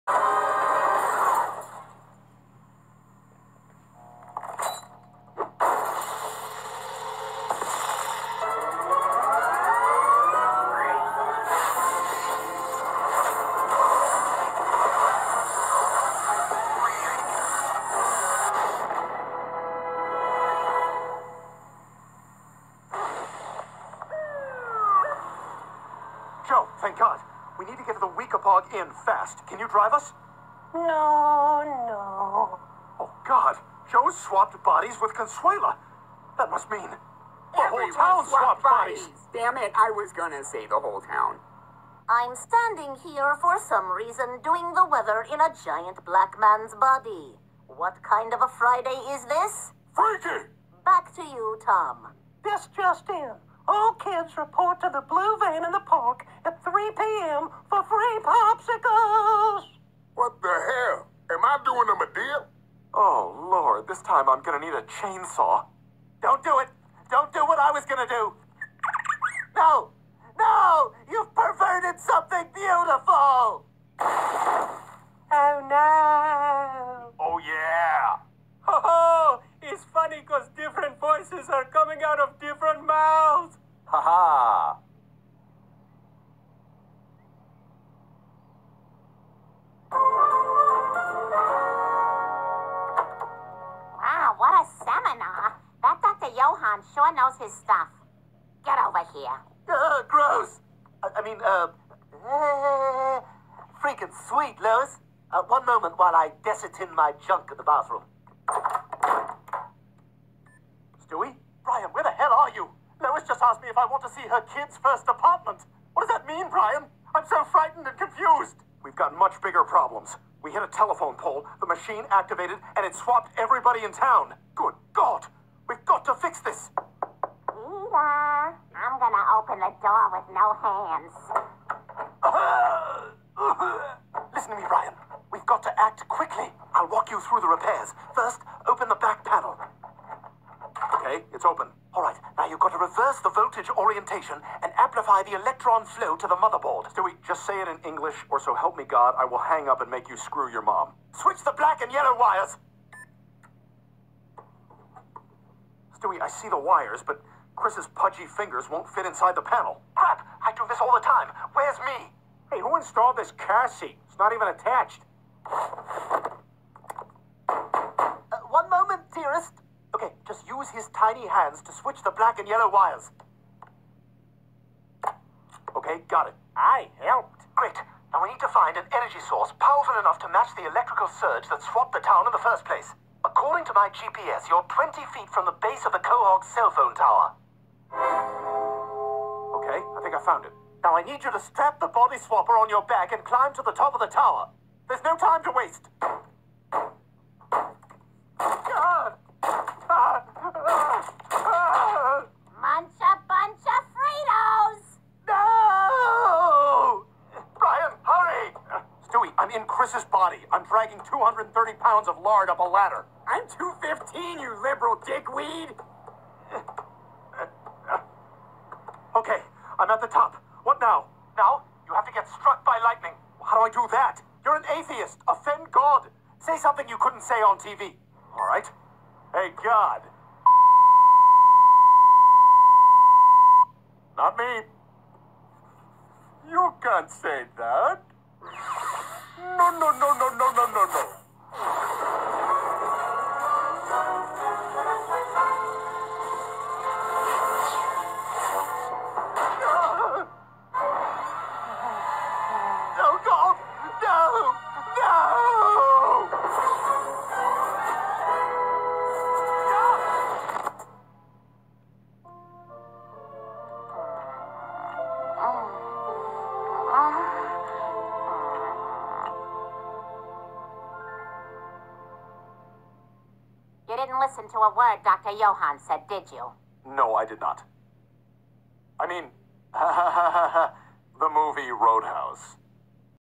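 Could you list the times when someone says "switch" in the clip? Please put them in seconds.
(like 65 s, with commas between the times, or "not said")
151 s, 171 s.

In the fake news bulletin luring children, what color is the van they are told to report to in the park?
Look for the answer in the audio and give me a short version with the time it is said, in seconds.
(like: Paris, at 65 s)
blue, at 55 s.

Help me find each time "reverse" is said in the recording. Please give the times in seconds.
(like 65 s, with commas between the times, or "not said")
142 s.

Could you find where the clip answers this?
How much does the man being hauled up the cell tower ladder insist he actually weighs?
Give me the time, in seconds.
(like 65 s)
213 s.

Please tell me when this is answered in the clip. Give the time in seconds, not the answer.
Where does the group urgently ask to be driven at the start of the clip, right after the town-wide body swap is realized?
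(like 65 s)
28 s.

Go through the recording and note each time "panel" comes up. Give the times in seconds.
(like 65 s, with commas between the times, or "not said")
139 s, 159 s.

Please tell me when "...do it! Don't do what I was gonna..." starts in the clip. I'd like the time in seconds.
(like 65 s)
66 s.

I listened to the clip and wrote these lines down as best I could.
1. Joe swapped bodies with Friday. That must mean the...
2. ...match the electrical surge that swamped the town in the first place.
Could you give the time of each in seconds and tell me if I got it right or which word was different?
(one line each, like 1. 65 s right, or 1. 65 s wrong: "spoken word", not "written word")
1. 33 s wrong: "Consuela", not "Friday"
2. 180 s right.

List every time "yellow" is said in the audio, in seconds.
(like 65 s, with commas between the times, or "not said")
151 s, 172 s.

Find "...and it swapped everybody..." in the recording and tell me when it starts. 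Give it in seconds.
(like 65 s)
122 s.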